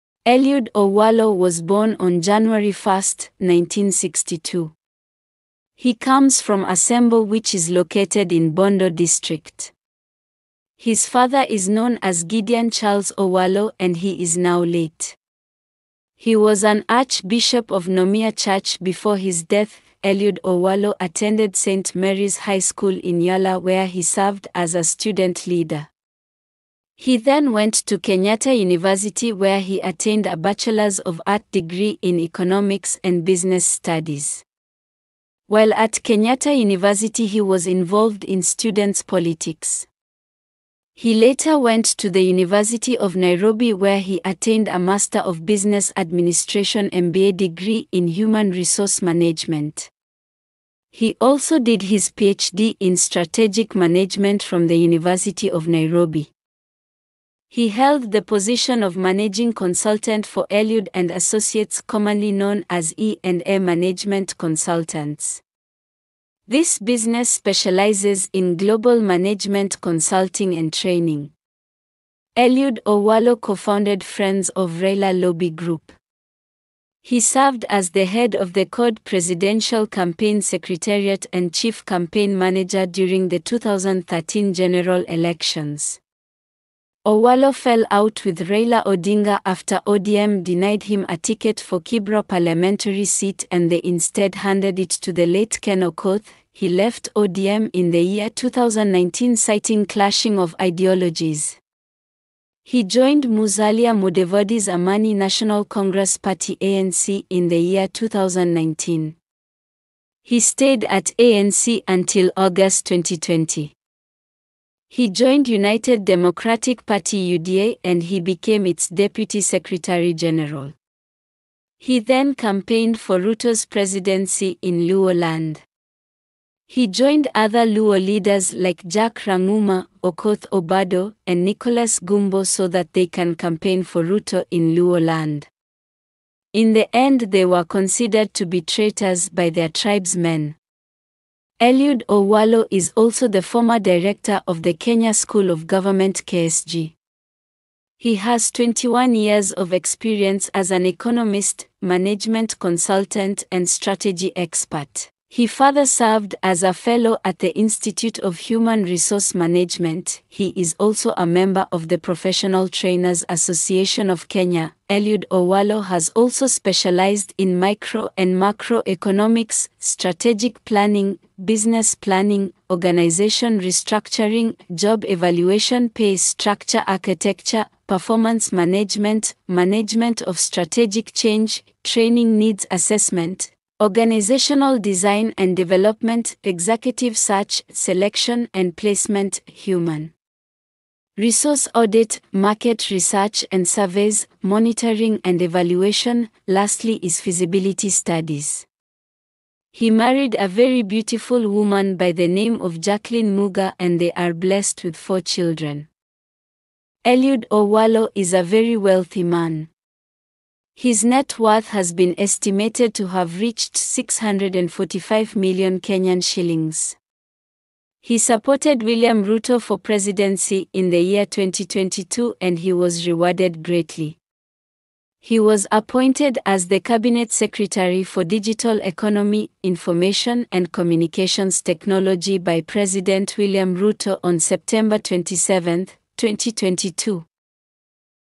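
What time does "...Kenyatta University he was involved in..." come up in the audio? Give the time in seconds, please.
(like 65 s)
36 s.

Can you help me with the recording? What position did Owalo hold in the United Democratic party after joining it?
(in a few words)
Deputy Secretary General.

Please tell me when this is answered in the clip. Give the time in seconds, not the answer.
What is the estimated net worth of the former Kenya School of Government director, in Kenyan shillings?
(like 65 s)
213 s.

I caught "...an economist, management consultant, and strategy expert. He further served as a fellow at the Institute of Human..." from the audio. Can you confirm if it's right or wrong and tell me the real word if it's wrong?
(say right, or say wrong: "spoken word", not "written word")
right.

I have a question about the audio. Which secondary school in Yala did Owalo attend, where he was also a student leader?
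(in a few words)
St. Mary's High School.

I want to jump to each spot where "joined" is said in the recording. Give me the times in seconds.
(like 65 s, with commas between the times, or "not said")
102 s, 115 s, 126 s.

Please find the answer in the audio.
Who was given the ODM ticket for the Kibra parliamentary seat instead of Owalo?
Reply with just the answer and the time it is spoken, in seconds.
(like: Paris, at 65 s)
Ken Okoth, at 95 s.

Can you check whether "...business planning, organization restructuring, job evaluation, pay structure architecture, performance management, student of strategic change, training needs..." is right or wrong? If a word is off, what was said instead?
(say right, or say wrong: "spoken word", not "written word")
wrong: "management", not "student".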